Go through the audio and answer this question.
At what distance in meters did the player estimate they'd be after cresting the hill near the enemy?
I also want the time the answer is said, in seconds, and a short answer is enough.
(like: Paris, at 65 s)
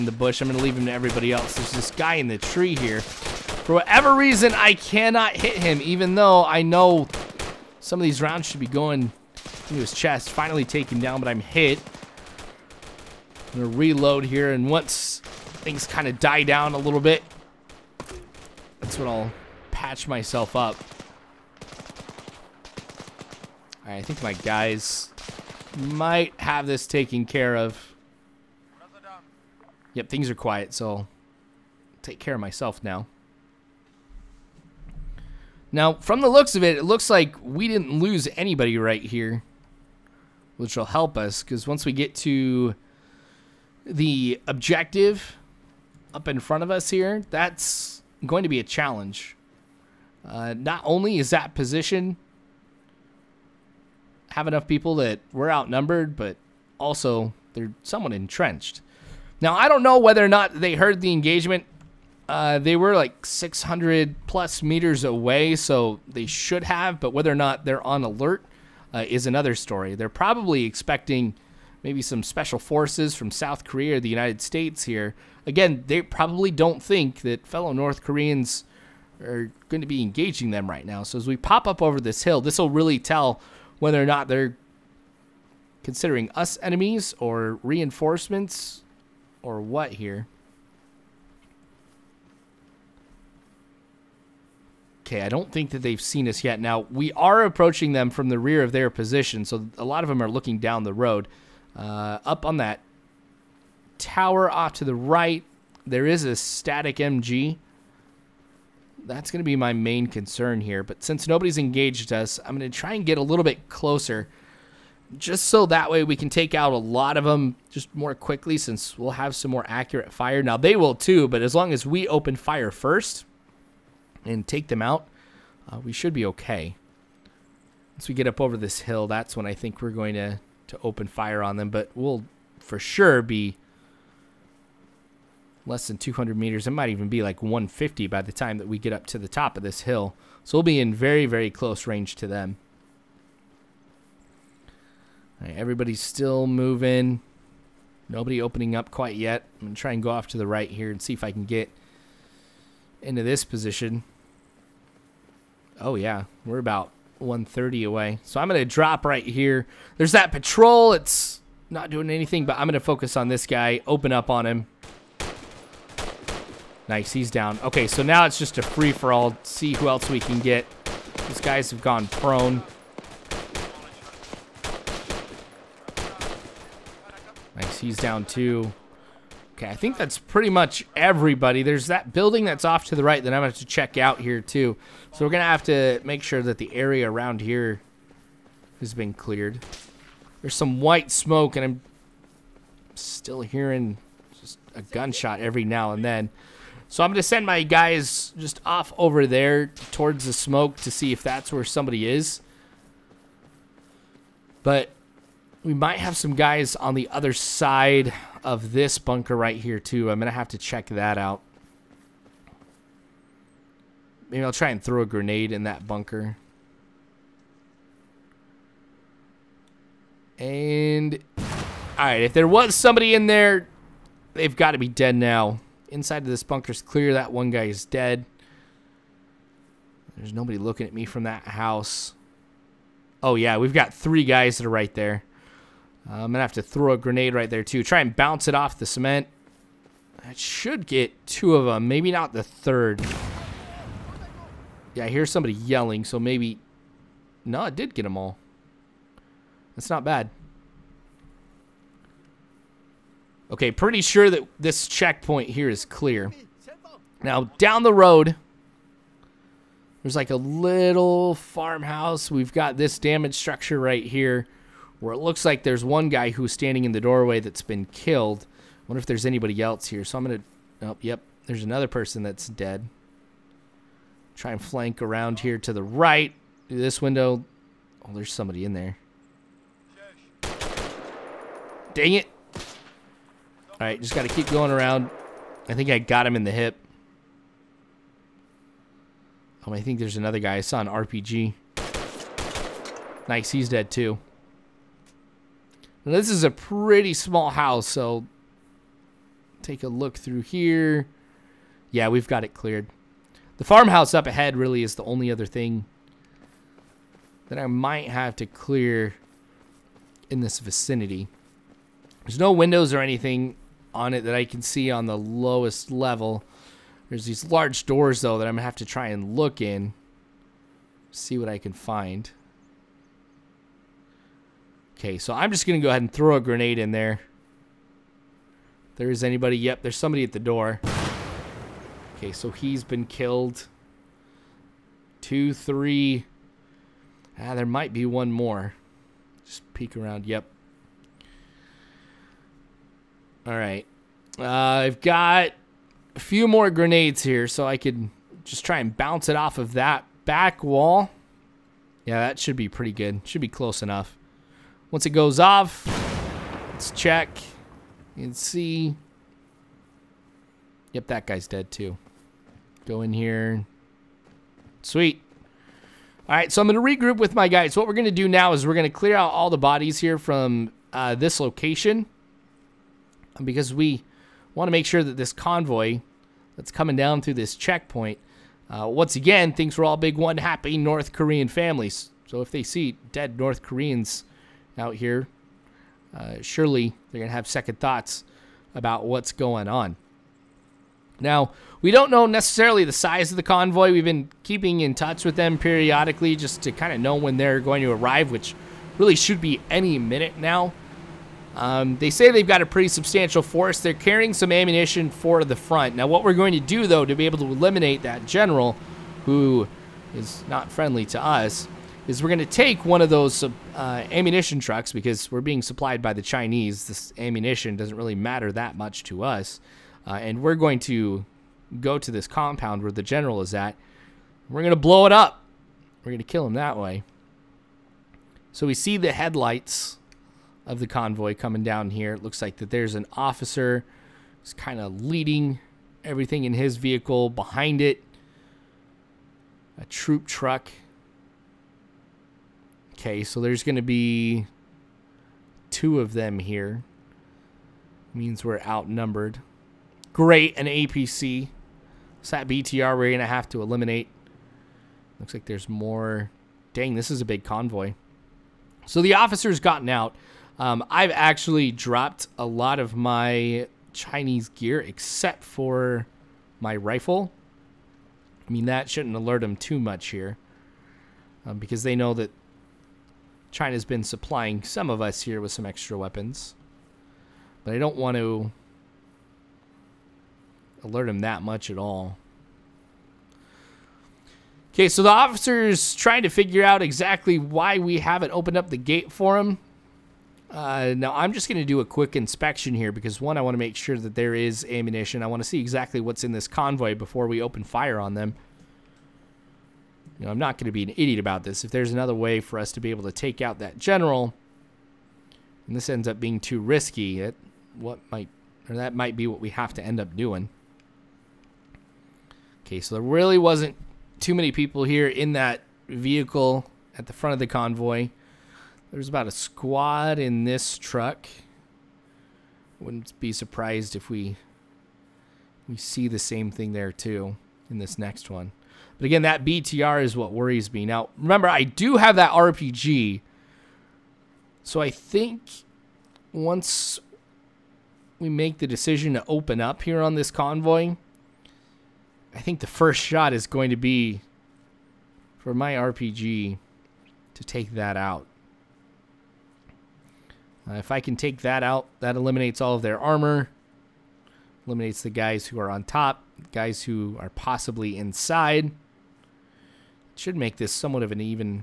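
150, at 137 s.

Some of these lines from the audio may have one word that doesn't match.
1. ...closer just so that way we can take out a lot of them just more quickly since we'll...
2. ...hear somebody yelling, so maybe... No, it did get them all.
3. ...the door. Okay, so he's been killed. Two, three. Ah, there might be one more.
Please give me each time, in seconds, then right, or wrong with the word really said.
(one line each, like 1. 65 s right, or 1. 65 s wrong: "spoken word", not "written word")
1. 113 s right
2. 245 s right
3. 330 s right.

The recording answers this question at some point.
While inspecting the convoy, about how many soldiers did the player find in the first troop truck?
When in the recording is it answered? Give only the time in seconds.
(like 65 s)
519 s.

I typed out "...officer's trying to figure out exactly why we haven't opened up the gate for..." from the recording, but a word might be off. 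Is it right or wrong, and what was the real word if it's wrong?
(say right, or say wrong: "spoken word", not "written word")
right.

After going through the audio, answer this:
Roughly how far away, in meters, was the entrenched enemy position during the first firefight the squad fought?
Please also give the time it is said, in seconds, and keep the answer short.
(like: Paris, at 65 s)
600, at 63 s.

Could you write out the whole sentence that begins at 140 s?
So we'll be in very, very close range to them.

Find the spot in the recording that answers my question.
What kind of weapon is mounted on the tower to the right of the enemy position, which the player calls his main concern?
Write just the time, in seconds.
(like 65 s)
106 s.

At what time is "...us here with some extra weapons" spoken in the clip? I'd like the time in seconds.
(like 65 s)
474 s.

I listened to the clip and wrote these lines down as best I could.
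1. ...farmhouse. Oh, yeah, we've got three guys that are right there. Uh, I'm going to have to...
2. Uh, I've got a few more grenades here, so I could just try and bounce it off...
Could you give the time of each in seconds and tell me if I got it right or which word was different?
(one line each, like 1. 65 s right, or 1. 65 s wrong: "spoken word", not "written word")
1. 231 s wrong: "house", not "farmhouse"
2. 344 s right.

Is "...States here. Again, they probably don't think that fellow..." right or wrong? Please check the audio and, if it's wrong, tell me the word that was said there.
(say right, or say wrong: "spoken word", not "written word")
right.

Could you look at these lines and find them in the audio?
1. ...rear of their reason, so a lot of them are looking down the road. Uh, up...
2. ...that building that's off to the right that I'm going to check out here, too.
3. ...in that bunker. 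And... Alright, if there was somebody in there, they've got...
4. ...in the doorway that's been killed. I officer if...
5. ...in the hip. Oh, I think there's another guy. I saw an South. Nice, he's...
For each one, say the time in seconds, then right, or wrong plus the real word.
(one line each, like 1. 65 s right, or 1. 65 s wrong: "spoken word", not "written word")
1. 98 s wrong: "position", not "reason"
2. 181 s right
3. 215 s right
4. 266 s wrong: "wonder", not "officer"
5. 286 s wrong: "RPG", not "South".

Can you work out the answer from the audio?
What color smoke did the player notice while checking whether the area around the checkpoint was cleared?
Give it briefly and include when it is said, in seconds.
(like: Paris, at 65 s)
White, at 190 s.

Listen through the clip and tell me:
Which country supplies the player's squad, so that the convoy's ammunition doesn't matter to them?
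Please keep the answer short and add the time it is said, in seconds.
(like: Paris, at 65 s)
China, at 416 s.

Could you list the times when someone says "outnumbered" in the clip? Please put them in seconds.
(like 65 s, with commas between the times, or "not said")
55 s, 448 s.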